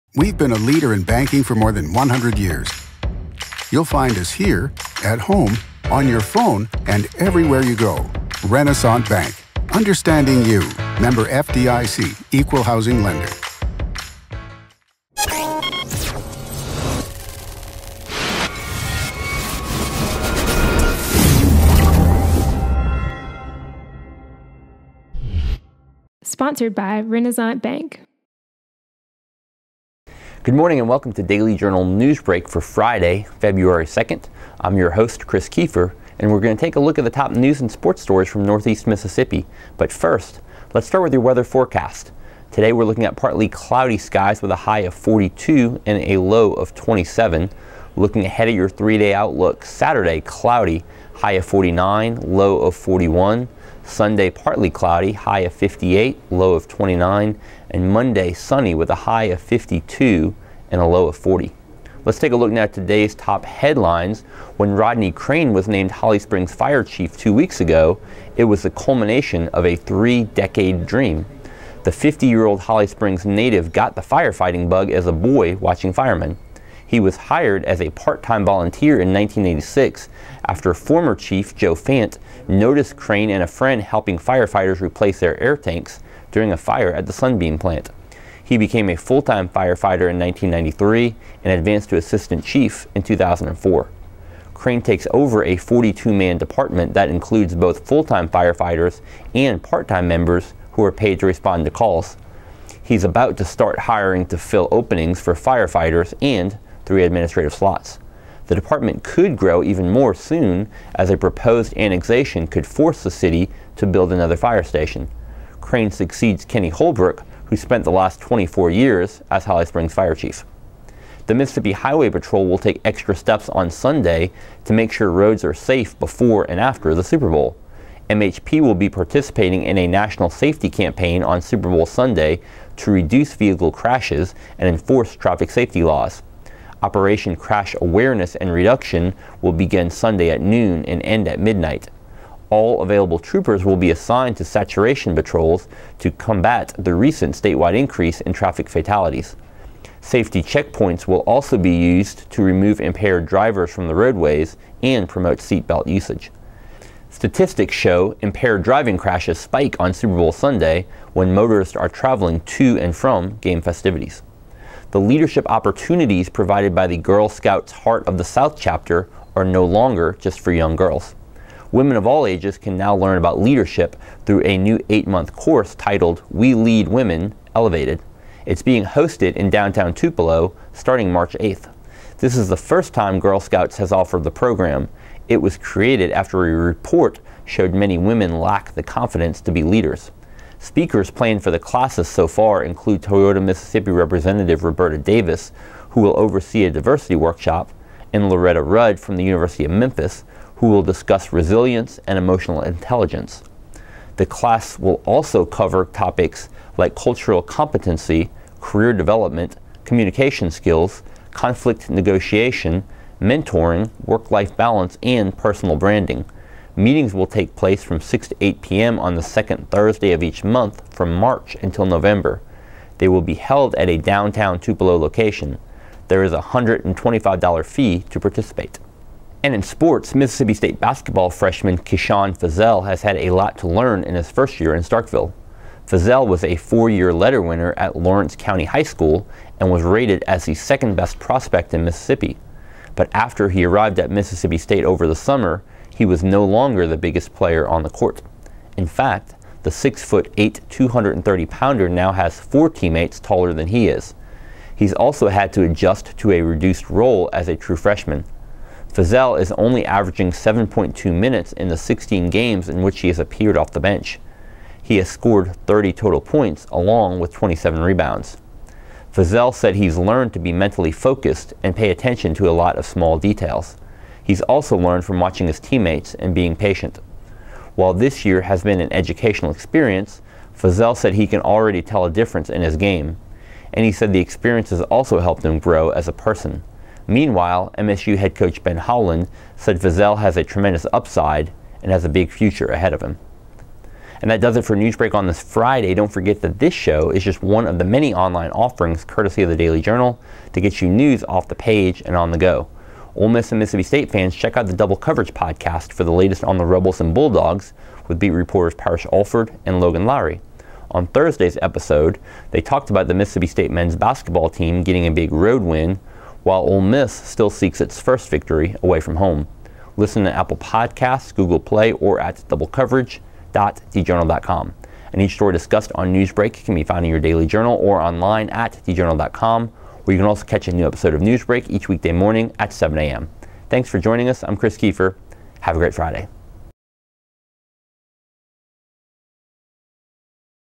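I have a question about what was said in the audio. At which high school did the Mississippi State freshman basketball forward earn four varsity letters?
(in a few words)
Lawrence County High School.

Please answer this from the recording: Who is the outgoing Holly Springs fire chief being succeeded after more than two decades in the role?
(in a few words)
Kenny Holbrook.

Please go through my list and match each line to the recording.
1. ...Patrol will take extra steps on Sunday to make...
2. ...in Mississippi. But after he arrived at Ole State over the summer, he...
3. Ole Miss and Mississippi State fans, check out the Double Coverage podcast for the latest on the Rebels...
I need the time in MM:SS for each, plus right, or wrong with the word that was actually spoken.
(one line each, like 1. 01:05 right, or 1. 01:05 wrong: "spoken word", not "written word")
1. 02:02 right
2. 04:01 wrong: "Mississippi", not "Ole"
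3. 05:03 right.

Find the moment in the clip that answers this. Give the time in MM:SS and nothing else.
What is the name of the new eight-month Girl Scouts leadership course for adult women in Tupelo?
02:56.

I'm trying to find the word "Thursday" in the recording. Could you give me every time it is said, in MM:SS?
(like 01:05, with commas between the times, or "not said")
03:39, 05:11.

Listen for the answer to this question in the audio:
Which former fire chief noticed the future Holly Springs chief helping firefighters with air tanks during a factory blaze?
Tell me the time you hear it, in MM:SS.
01:21.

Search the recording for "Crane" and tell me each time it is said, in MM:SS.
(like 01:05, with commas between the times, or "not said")
01:05, 01:22, 01:34, 01:55.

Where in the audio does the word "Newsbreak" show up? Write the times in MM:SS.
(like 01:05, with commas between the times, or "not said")
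00:31, 04:54, 05:26, 05:31.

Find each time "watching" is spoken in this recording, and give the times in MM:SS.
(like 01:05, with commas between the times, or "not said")
01:15, 04:35.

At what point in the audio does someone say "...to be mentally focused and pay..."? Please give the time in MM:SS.
04:30.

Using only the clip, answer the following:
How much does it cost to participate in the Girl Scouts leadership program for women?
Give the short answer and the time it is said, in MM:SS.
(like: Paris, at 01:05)
$125, at 03:46.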